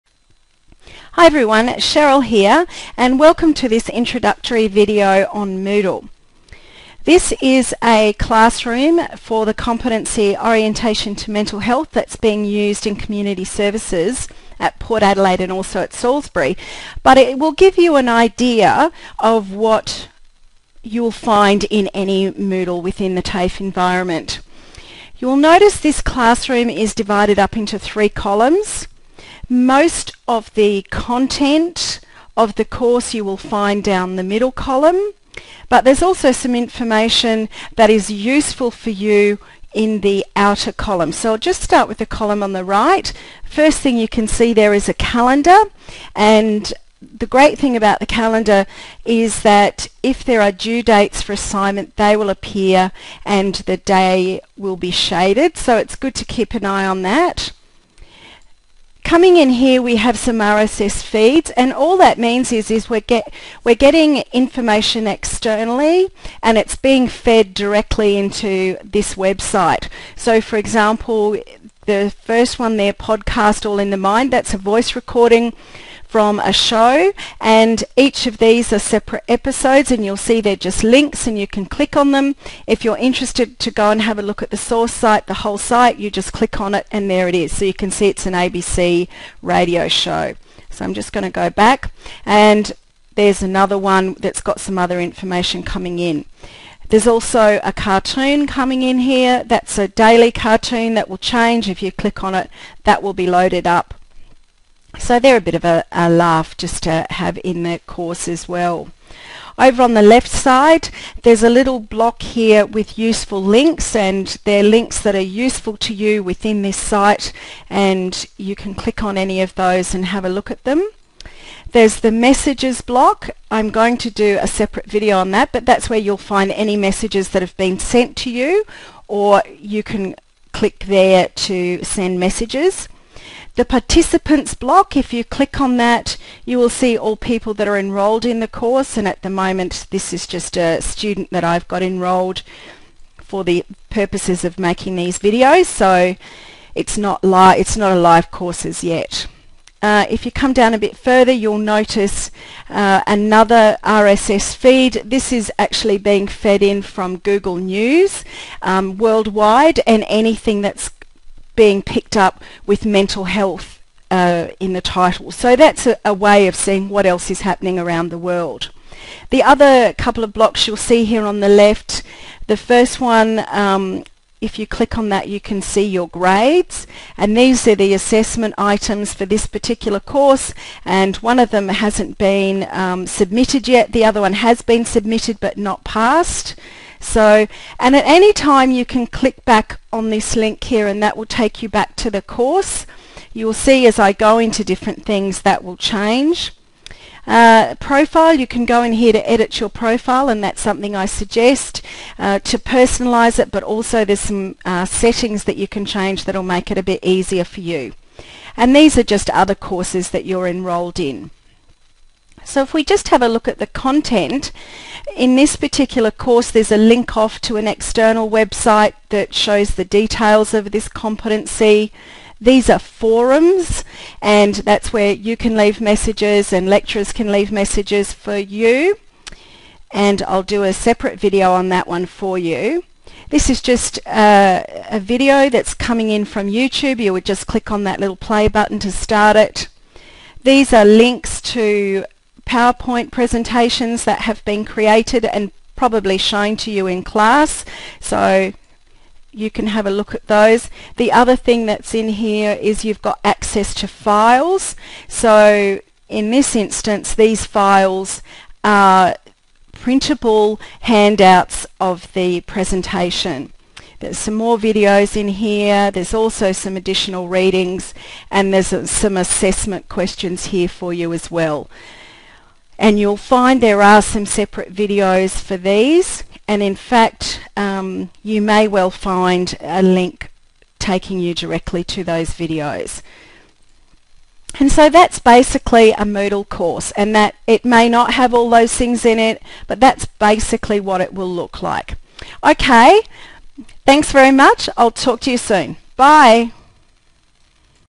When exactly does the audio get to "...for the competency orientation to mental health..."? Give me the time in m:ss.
0:09.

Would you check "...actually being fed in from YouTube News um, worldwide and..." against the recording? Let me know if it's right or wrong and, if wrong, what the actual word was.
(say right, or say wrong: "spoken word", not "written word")
wrong: "Google", not "YouTube".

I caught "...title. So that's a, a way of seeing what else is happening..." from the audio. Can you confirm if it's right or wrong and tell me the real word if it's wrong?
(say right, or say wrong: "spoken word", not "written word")
right.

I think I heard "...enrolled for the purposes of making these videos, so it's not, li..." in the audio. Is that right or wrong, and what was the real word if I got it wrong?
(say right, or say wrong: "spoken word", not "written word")
right.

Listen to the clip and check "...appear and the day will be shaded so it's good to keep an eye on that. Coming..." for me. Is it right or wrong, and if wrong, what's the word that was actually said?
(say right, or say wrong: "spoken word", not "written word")
right.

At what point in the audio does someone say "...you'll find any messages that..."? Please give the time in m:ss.
2:05.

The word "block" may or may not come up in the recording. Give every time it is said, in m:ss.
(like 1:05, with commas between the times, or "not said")
1:51, 2:02, 2:14, 2:50.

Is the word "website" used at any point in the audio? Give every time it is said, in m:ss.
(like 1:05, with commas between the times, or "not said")
1:09, 3:38.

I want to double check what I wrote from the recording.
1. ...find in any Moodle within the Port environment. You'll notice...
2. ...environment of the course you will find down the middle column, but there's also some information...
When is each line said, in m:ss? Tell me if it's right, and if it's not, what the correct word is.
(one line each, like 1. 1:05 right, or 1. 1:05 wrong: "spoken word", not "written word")
1. 0:21 wrong: "TAFE", not "Port"
2. 0:30 wrong: "content", not "environment".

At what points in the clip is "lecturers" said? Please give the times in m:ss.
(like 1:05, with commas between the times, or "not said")
3:46.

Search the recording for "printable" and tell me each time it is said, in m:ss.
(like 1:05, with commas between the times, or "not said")
4:19.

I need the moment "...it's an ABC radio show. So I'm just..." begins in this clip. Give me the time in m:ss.
1:28.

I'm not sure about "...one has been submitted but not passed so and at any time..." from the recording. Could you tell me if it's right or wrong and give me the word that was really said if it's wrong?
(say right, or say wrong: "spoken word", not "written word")
right.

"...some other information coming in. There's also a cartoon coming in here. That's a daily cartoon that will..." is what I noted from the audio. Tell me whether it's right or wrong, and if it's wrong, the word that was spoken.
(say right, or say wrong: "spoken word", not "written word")
right.